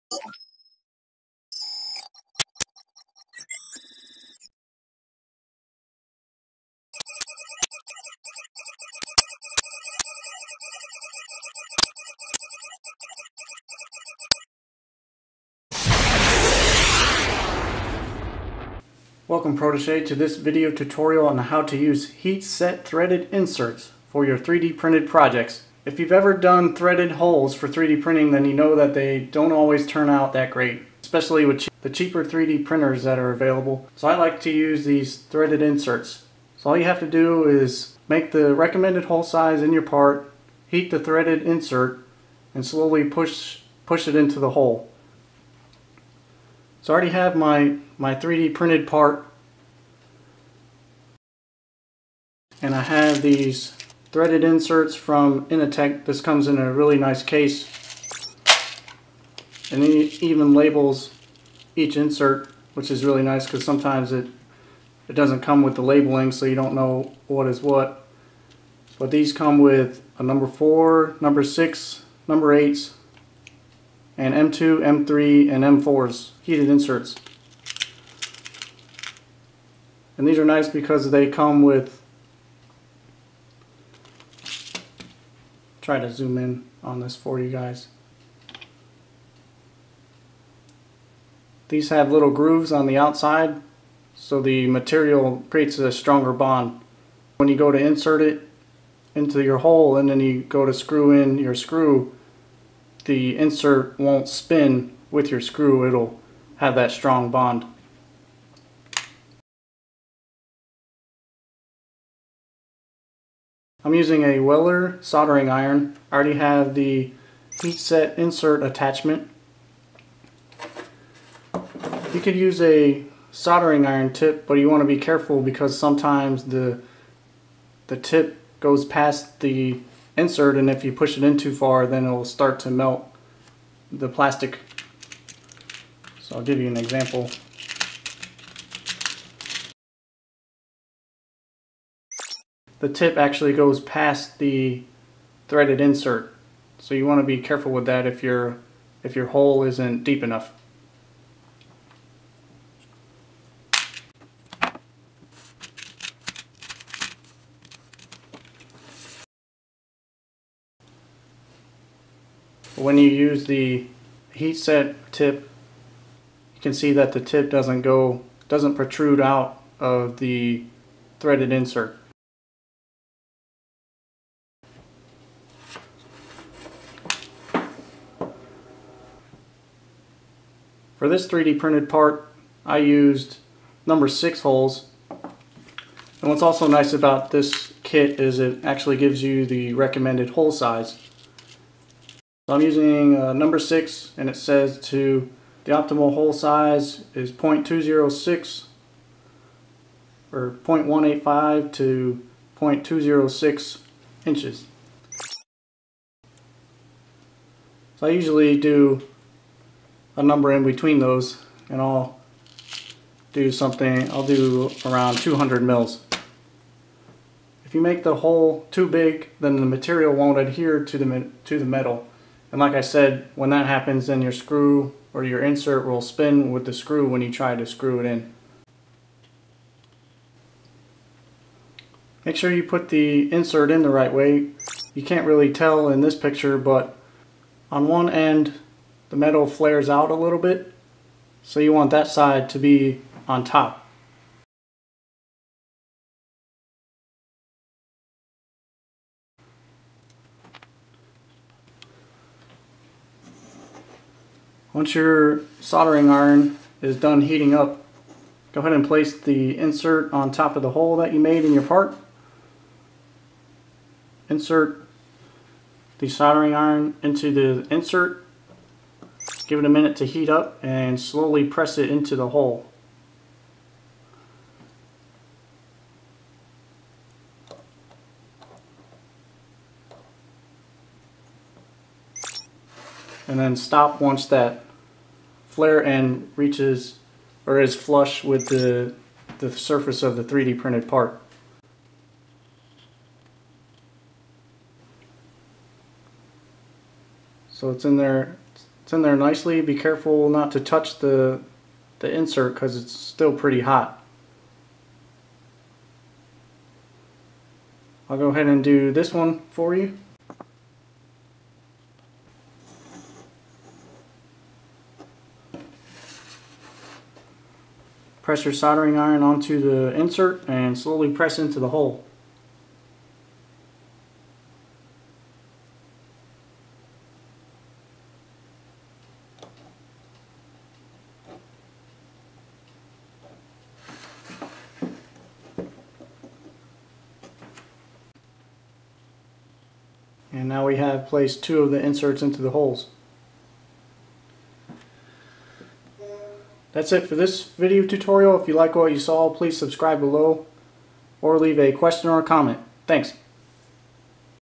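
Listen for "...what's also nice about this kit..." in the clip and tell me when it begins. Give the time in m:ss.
3:06.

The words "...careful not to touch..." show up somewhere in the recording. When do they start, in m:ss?
4:59.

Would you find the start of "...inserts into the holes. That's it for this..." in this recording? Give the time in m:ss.
5:41.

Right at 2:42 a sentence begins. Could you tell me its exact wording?
When you use the heat set tip, you can see that the tip doesn't go doesn't protrude out of the threaded insert.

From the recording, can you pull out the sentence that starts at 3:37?
If you make the hole too big, then the material won't adhere to the, to the metal.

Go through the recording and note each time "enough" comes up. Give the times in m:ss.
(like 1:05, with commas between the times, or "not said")
2:30.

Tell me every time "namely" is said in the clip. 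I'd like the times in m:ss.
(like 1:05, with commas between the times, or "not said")
not said.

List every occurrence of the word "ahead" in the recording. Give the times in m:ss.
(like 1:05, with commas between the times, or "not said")
4:18, 5:08.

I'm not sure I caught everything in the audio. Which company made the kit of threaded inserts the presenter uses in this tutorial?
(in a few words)
Initeq.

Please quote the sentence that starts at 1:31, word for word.
These have little grooves on the outside so the material creates a stronger bond.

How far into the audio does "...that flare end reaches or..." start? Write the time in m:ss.
4:44.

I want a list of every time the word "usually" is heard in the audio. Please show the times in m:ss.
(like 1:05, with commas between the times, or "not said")
3:28.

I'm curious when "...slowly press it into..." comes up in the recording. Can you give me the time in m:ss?
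4:30.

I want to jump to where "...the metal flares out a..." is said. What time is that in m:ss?
3:59.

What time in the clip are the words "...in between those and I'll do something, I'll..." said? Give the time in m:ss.
3:30.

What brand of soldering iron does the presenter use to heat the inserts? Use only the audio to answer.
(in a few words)
Weller.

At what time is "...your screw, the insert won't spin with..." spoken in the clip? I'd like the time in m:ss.
1:41.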